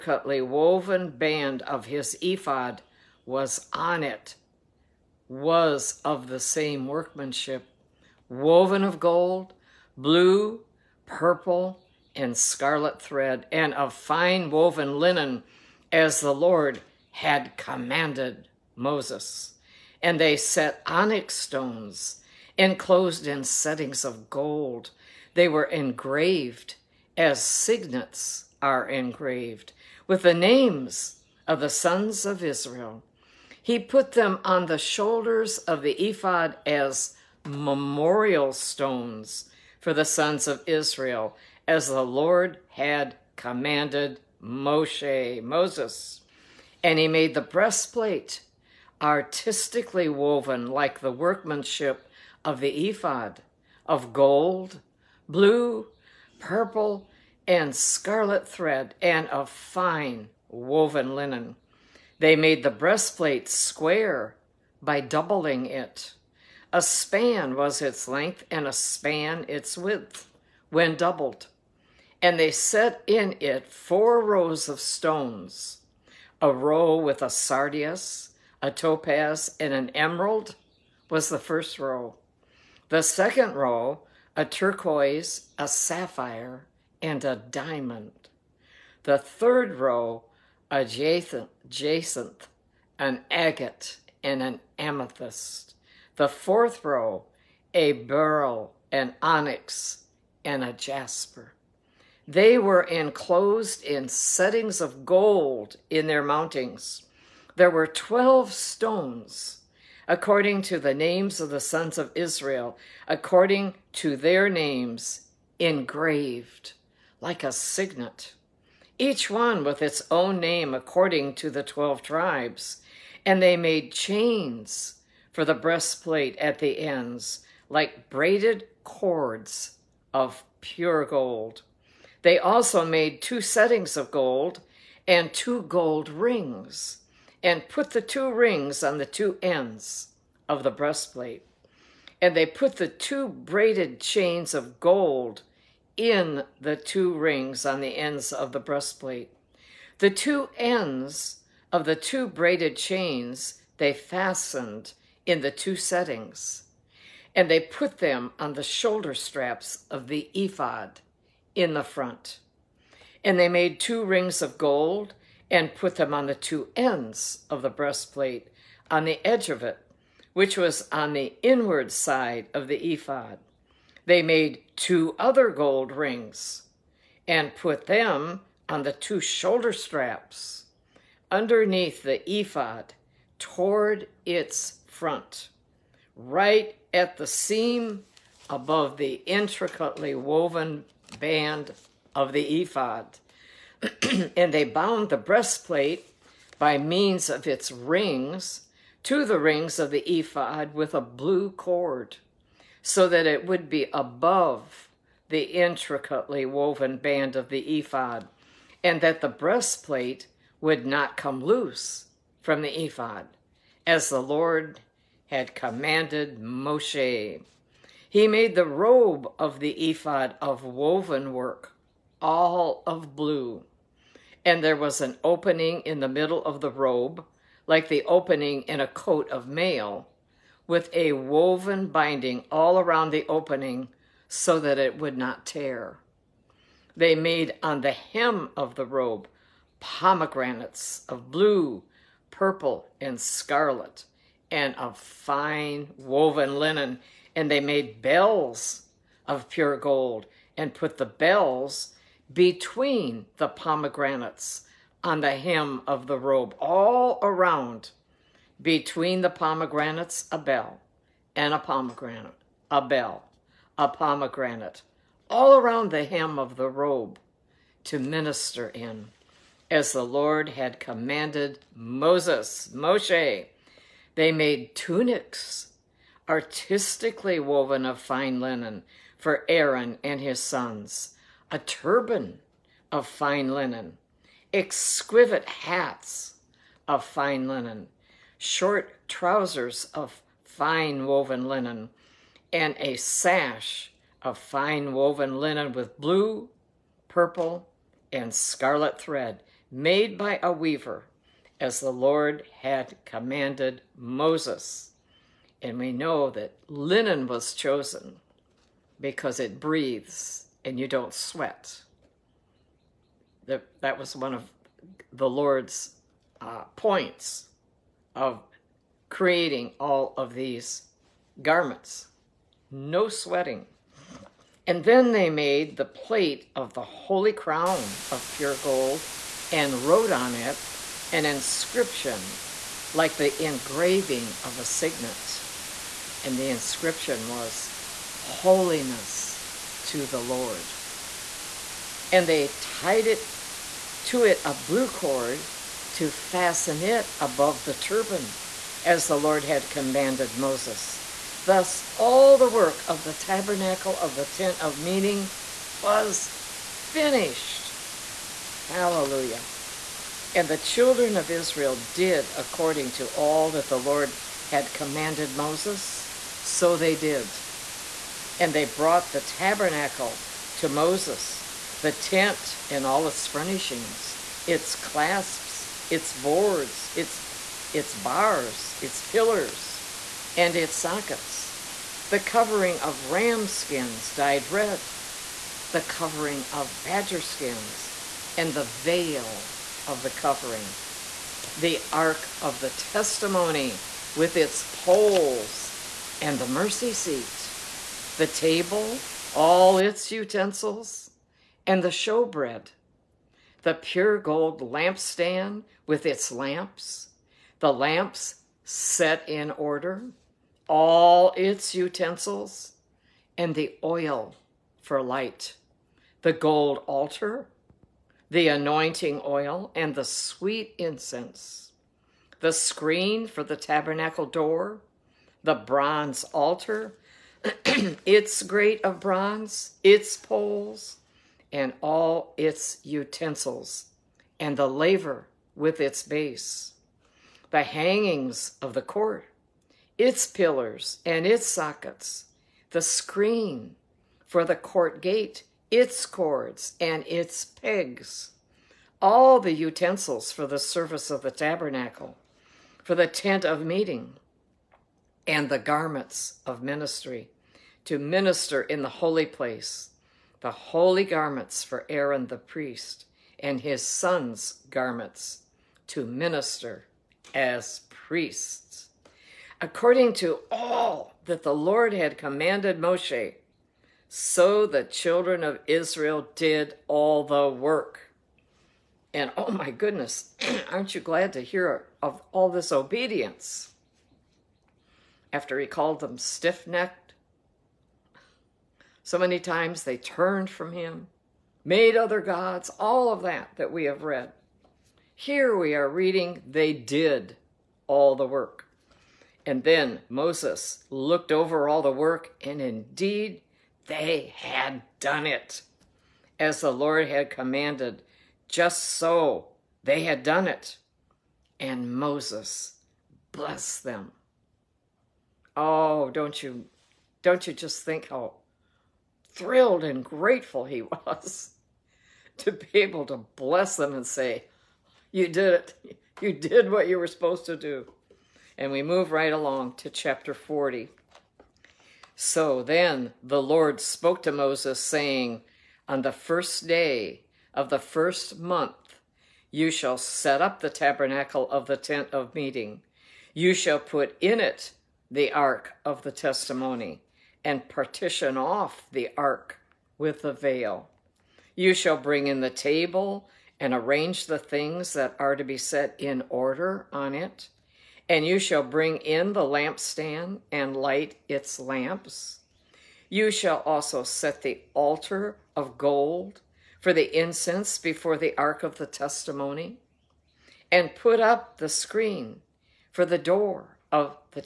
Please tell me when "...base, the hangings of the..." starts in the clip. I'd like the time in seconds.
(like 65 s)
436 s.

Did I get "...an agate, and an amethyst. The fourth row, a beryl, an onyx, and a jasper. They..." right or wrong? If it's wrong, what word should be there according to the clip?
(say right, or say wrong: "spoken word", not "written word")
right.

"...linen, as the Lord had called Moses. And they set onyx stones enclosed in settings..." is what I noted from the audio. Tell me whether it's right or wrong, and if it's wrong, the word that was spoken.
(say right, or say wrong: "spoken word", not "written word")
wrong: "commanded", not "called".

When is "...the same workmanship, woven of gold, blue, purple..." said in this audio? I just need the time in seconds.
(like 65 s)
6 s.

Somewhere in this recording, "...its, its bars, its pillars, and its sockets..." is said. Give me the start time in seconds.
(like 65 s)
376 s.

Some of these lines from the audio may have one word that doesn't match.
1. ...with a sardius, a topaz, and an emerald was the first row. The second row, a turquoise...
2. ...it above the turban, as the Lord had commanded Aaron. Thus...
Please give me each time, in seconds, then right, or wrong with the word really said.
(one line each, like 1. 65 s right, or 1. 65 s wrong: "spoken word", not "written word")
1. 76 s right
2. 346 s wrong: "Moses", not "Aaron".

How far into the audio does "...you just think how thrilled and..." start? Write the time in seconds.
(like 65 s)
517 s.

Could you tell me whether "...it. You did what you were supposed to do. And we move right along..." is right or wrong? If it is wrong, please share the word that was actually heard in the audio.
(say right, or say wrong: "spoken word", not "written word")
right.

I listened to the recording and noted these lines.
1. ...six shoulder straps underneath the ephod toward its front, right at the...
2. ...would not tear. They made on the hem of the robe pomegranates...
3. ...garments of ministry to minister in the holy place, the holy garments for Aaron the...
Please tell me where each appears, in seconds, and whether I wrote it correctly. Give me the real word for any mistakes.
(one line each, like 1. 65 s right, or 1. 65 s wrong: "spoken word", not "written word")
1. 178 s wrong: "two", not "six"
2. 234 s right
3. 455 s right.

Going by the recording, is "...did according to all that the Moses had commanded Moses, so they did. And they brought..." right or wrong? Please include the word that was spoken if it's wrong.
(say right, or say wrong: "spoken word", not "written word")
wrong: "Lord", not "Moses".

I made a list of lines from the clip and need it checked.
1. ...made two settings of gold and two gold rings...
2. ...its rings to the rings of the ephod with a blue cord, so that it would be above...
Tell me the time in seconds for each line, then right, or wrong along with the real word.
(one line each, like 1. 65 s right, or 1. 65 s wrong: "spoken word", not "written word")
1. 132 s right
2. 197 s right.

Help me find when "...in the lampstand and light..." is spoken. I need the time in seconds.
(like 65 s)
558 s.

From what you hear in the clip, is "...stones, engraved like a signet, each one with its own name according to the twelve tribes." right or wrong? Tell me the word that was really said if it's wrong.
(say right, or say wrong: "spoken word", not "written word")
wrong: "names", not "stones".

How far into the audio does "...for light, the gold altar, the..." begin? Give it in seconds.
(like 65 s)
414 s.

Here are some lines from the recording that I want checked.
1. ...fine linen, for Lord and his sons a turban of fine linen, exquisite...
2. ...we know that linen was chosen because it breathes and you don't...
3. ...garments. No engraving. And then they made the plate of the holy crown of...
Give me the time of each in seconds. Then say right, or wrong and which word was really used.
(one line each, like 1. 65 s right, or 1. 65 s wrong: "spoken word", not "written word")
1. 277 s wrong: "Aaron", not "Lord"
2. 305 s right
3. 321 s wrong: "sweating", not "engraving".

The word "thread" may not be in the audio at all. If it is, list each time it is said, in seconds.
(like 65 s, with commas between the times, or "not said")
12 s, 58 s, 298 s.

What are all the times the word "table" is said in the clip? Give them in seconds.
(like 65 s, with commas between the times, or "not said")
398 s, 552 s.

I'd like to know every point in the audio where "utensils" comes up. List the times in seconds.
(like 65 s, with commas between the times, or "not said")
400 s, 411 s, 432 s, 449 s.